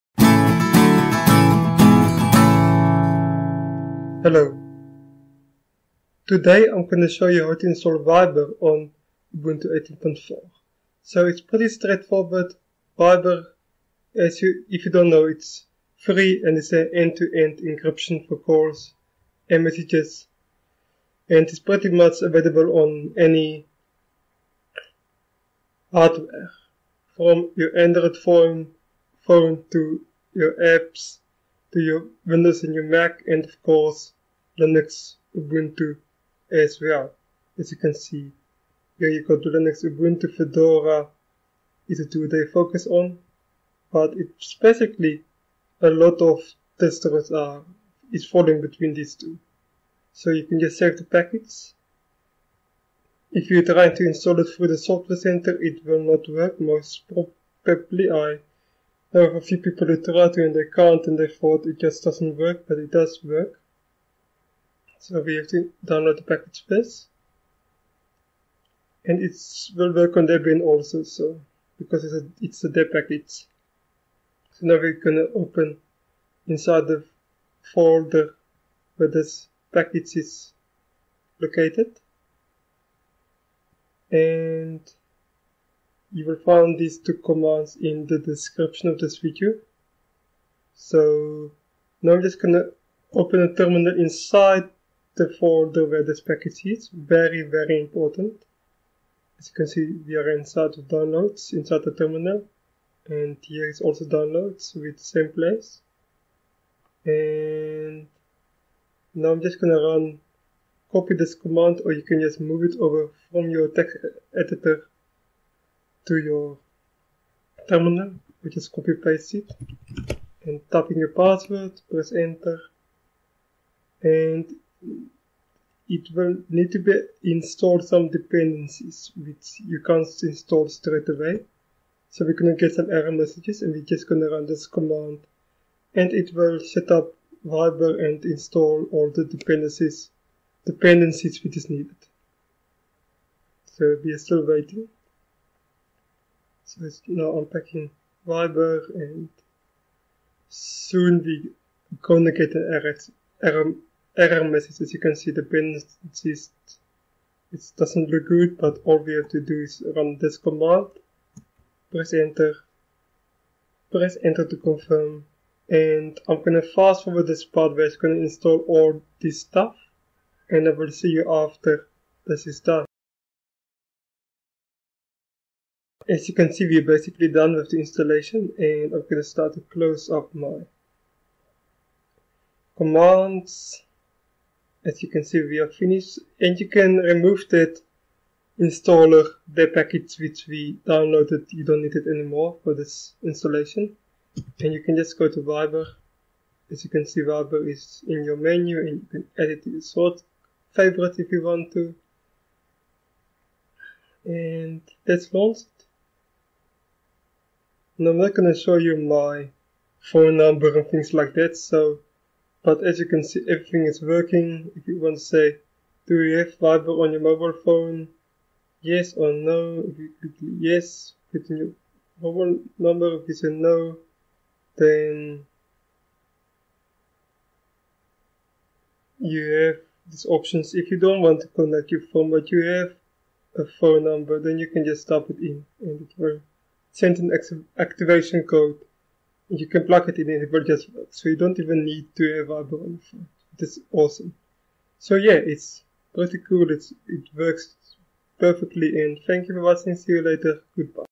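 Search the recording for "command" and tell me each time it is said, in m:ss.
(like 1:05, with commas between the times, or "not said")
1:27, 1:51, 2:14, 2:40, 3:02.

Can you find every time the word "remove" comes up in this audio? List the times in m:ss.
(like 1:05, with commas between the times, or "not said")
3:06.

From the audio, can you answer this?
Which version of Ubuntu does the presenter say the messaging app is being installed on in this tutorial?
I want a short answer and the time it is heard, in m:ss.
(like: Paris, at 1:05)
18.4, at 0:09.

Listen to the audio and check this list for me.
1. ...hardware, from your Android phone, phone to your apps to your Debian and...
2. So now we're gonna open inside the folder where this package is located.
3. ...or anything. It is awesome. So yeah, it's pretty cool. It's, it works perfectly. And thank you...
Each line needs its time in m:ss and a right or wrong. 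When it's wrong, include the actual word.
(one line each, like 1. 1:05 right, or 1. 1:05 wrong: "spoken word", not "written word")
1. 0:25 wrong: "Windows", not "Debian"
2. 1:14 right
3. 4:02 right.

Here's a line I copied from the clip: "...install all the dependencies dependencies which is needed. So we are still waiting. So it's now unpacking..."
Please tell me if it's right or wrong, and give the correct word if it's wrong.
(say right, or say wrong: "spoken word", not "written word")
right.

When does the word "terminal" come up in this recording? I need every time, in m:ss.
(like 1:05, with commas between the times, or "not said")
1:33, 1:41, 1:57.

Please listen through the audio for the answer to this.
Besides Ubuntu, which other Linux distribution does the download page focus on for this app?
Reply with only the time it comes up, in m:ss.
0:40.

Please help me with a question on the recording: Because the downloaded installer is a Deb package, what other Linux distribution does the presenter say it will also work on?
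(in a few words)
Debian.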